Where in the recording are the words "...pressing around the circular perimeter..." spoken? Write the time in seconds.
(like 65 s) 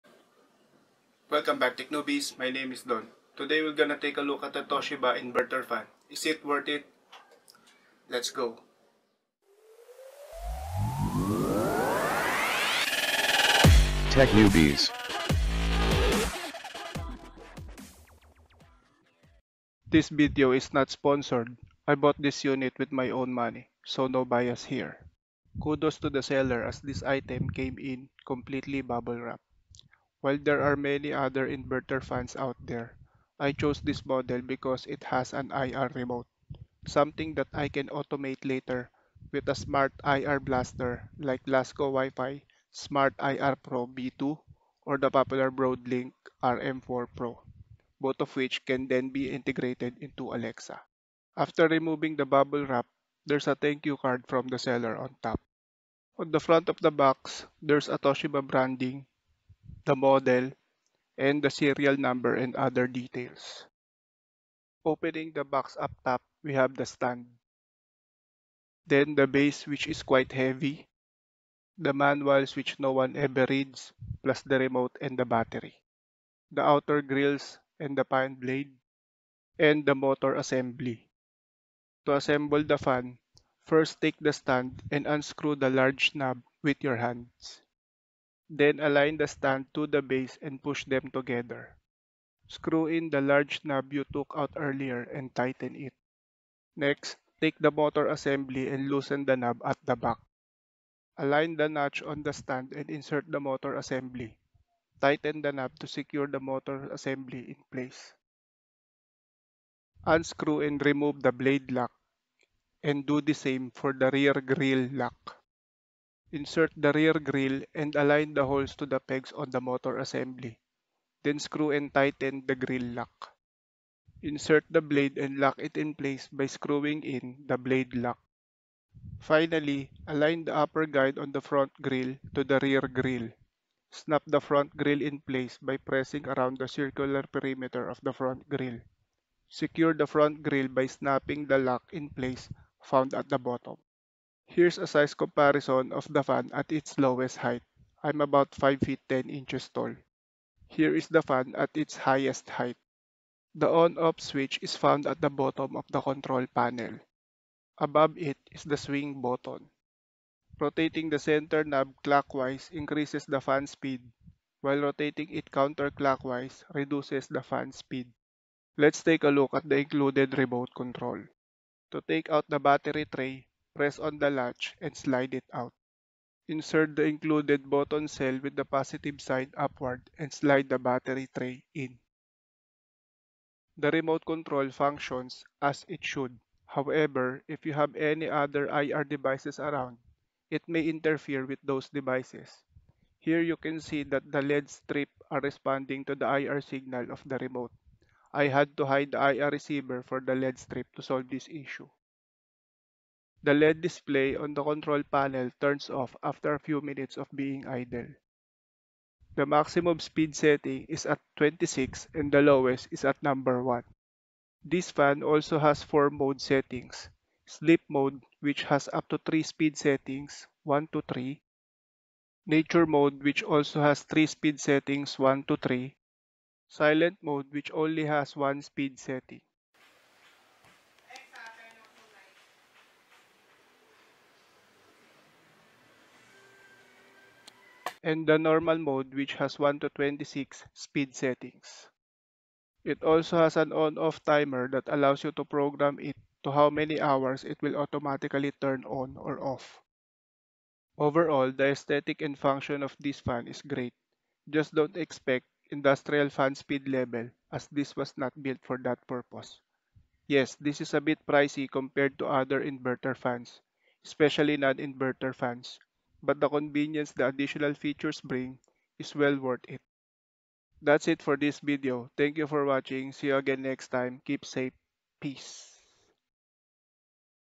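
135 s.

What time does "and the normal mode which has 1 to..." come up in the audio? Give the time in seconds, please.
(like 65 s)
238 s.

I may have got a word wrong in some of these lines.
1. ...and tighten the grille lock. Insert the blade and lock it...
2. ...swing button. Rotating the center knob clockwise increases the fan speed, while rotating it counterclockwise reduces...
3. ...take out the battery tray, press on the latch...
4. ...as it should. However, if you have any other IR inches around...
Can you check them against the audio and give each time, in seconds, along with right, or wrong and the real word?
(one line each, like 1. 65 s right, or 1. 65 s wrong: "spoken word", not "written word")
1. 121 s right
2. 158 s right
3. 172 s right
4. 185 s wrong: "devices", not "inches".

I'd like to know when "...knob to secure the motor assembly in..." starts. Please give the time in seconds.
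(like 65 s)
105 s.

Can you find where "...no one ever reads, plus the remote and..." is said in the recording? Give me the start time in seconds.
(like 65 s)
72 s.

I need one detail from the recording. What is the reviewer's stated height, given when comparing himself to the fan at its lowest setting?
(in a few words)
5 feet 10 inches.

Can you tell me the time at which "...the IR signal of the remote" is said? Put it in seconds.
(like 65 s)
196 s.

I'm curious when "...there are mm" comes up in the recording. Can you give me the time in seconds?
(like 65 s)
30 s.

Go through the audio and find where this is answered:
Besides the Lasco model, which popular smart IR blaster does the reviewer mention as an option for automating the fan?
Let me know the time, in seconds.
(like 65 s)
45 s.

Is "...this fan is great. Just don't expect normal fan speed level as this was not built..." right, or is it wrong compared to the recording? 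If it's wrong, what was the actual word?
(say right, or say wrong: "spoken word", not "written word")
wrong: "industrial", not "normal".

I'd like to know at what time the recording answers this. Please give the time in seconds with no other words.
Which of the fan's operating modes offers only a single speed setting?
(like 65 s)
226 s.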